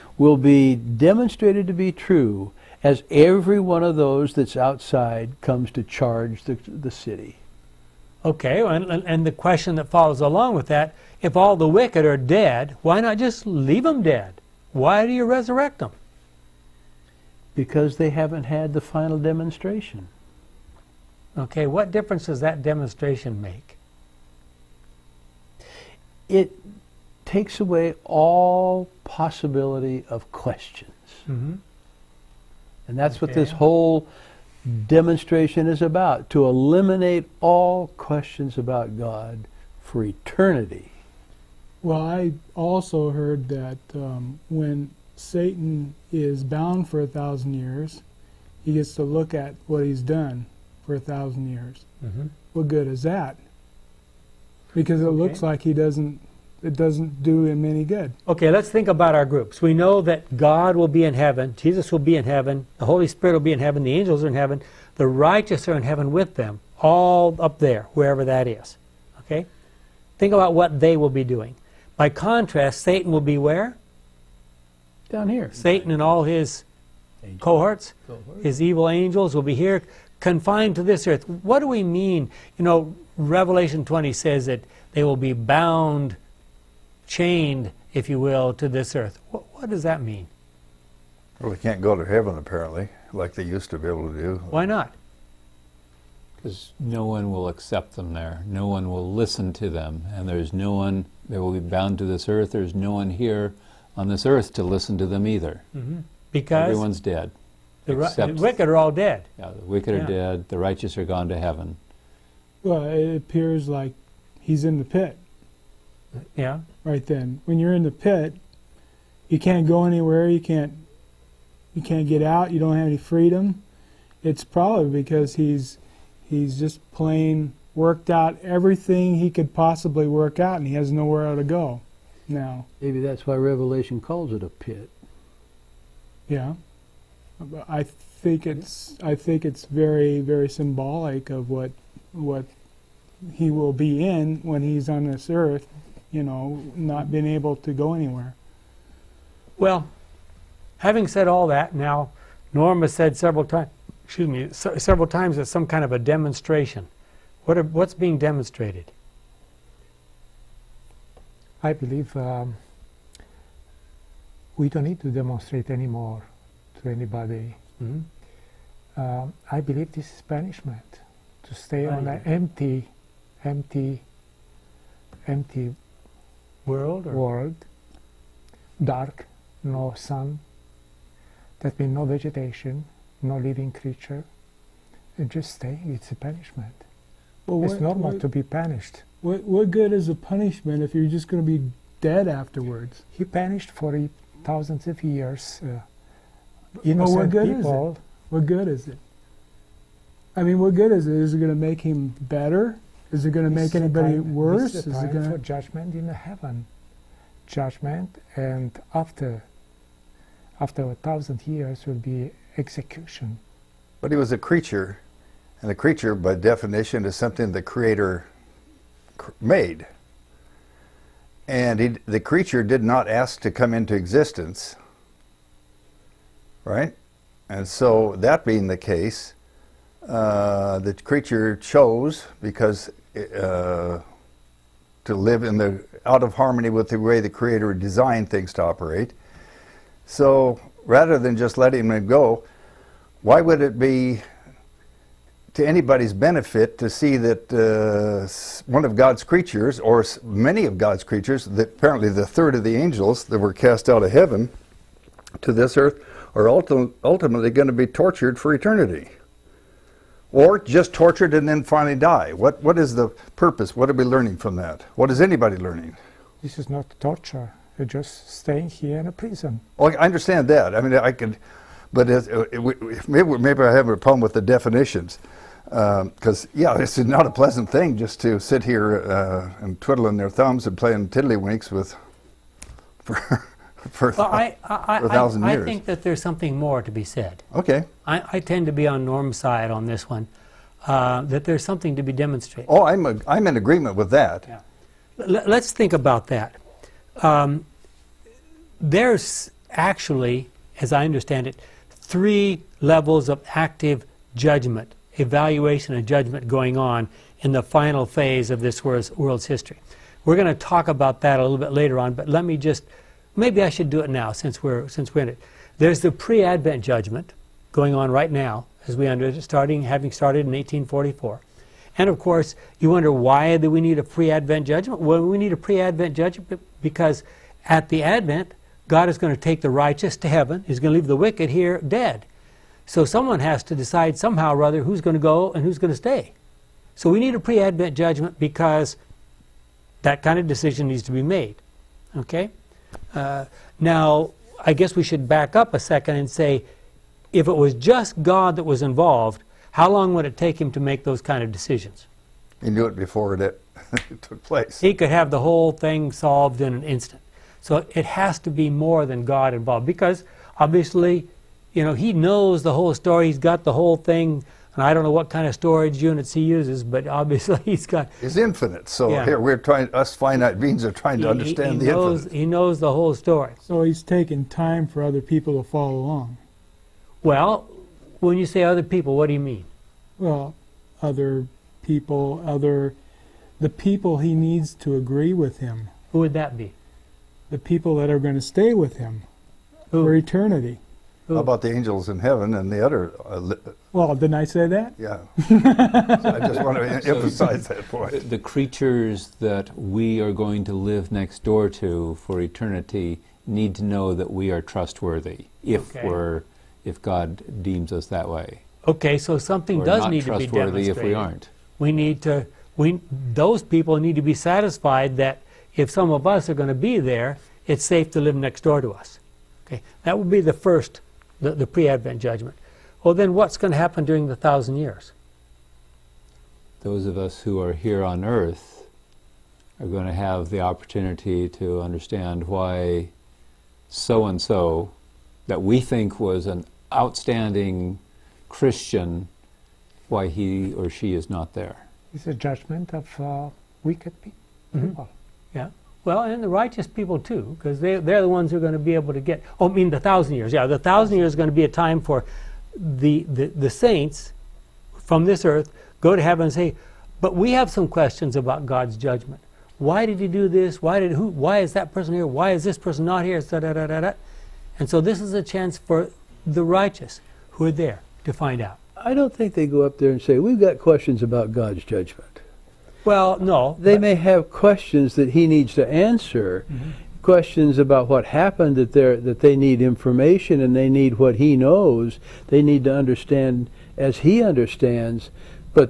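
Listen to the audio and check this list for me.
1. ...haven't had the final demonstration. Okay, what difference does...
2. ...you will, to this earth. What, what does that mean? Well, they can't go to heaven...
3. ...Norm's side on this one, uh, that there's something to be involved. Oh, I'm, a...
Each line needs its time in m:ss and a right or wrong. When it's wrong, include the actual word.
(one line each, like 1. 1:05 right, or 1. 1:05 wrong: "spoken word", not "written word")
1. 0:18 right
2. 1:28 right
3. 4:49 wrong: "demonstrated", not "involved".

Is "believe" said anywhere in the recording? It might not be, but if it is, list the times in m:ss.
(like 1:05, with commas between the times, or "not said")
2:41, 2:49.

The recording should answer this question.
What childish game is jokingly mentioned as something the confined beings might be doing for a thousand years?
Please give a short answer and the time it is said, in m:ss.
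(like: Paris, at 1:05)
tiddlywinks, at 4:41.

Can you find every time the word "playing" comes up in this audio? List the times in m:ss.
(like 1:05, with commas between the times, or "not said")
4:40.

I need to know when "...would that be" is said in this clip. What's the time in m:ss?
6:26.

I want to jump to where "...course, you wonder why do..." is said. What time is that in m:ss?
5:22.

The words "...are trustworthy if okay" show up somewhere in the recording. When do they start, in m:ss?
6:44.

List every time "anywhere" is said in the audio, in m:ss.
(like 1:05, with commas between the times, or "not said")
1:59, 2:27.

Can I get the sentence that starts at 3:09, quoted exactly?
What, what good is a punishment if you're just going to be dead afterwards?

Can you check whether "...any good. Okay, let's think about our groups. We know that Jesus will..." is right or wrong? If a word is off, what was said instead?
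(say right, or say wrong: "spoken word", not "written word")
wrong: "God", not "Jesus".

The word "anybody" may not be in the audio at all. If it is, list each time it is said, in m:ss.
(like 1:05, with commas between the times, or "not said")
2:46, 3:23, 4:05, 4:25.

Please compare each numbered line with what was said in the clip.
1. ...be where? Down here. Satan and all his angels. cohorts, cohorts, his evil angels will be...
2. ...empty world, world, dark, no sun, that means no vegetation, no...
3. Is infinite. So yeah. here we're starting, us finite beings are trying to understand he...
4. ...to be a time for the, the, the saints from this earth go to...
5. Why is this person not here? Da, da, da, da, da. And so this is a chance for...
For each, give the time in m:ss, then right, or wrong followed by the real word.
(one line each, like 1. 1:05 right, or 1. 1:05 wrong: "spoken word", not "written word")
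1. 1:13 right
2. 2:55 right
3. 6:08 wrong: "trying", not "starting"
4. 7:31 right
5. 7:42 right.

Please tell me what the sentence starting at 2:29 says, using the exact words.
Well, having said all that, now Norma said several times, excuse me, several times it's some kind of a demonstration.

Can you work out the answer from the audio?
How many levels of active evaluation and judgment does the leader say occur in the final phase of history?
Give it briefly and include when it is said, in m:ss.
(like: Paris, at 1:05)
3, at 5:01.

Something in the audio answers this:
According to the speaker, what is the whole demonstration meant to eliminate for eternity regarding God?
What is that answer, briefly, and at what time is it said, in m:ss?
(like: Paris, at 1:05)
all questions, at 0:36.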